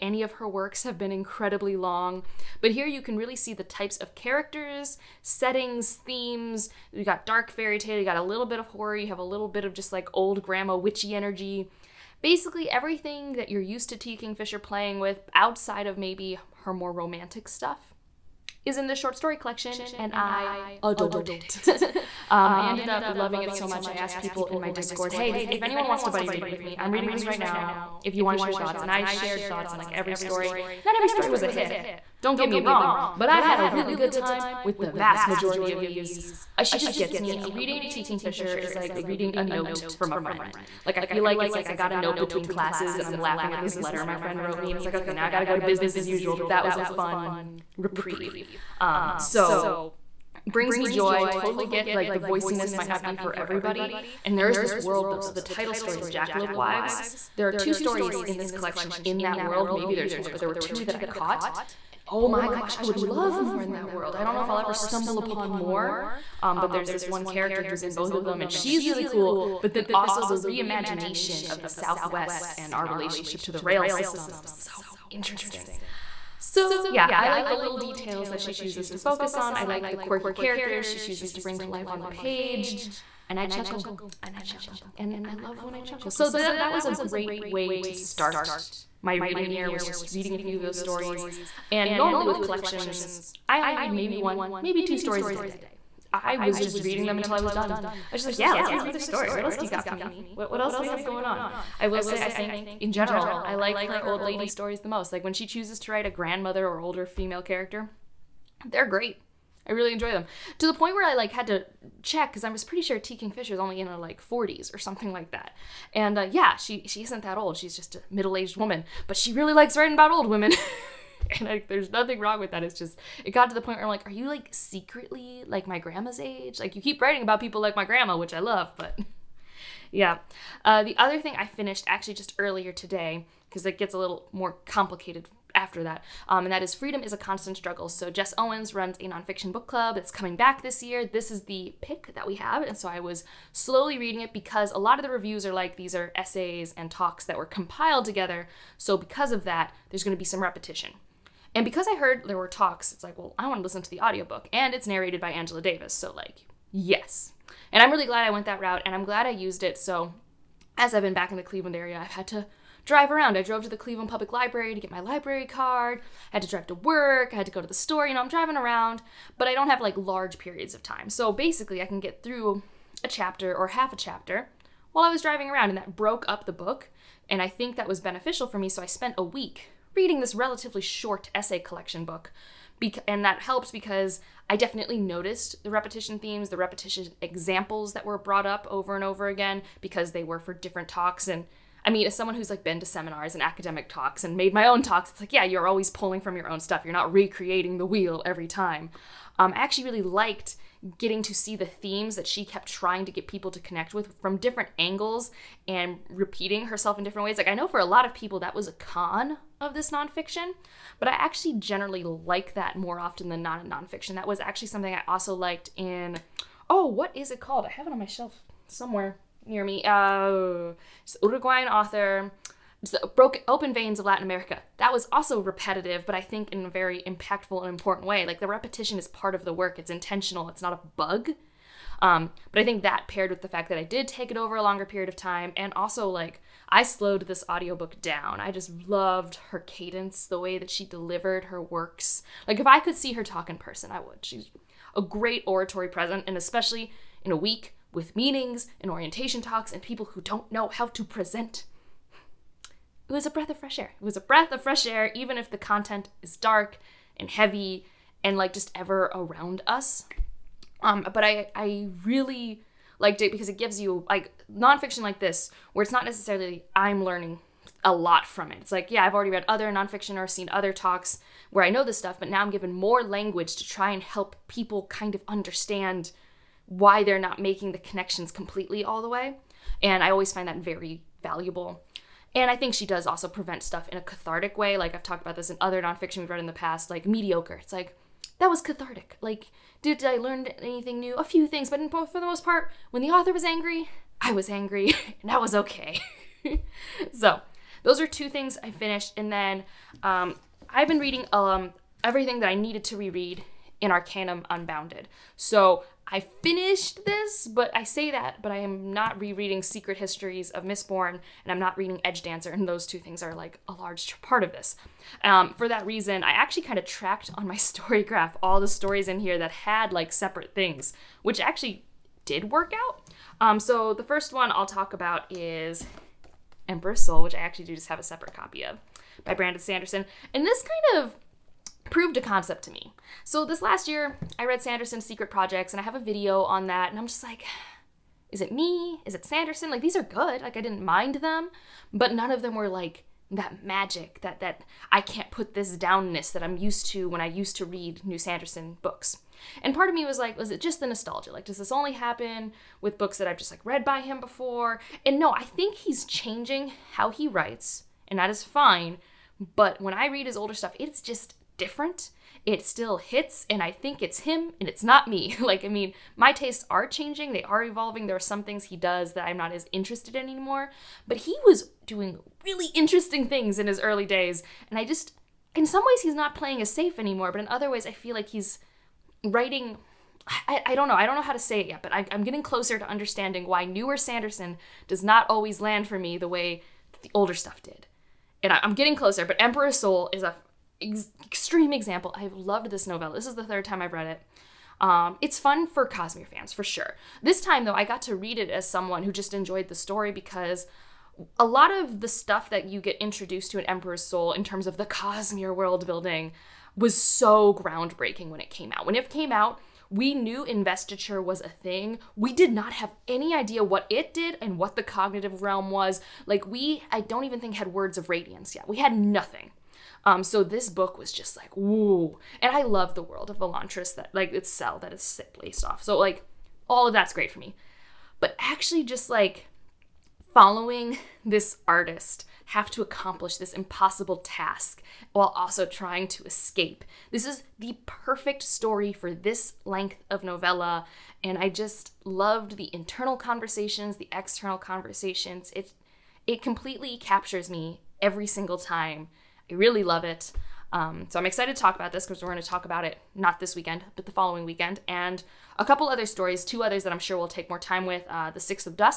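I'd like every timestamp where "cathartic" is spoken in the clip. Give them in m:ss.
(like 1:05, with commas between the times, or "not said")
4:44, 4:48.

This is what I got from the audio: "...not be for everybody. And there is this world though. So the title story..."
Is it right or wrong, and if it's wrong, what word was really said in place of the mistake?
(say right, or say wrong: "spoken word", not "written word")
right.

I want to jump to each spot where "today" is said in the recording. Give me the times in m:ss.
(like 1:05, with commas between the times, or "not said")
2:12.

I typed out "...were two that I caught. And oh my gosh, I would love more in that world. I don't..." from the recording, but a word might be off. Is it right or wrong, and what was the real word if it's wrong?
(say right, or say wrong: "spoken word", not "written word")
right.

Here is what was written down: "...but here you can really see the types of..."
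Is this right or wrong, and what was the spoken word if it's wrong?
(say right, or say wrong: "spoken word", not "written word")
right.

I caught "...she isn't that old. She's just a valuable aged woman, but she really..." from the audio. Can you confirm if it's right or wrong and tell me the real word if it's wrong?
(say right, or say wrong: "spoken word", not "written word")
wrong: "middle", not "valuable".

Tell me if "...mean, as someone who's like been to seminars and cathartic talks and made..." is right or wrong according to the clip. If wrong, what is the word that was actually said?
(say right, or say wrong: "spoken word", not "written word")
wrong: "academic", not "cathartic".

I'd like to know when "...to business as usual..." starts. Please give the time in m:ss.
0:45.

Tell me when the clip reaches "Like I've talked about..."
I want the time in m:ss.
4:44.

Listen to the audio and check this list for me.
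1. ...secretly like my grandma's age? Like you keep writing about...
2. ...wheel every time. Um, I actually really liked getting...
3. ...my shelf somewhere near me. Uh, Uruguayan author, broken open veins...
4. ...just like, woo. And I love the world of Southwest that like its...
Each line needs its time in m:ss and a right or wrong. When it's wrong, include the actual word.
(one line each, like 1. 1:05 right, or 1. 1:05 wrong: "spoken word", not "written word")
1. 2:04 right
2. 3:17 right
3. 3:37 right
4. 7:01 wrong: "Elantris", not "Southwest".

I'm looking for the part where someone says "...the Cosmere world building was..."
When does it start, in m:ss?
6:44.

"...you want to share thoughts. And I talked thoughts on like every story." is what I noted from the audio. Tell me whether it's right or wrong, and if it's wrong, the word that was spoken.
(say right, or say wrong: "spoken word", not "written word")
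wrong: "shared", not "talked".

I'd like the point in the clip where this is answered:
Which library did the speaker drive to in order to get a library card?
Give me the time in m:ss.
2:43.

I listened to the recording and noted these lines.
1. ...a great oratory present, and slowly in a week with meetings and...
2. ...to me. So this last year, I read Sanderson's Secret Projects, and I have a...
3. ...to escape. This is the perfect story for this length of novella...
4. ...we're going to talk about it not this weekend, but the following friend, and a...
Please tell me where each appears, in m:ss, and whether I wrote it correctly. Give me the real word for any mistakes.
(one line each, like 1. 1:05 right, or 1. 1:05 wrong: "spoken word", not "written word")
1. 4:04 wrong: "especially", not "slowly"
2. 5:32 right
3. 7:16 right
4. 7:32 wrong: "weekend", not "friend".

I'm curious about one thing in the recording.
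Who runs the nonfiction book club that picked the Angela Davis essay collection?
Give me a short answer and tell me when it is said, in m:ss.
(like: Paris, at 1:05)
Jess Owens, at 2:18.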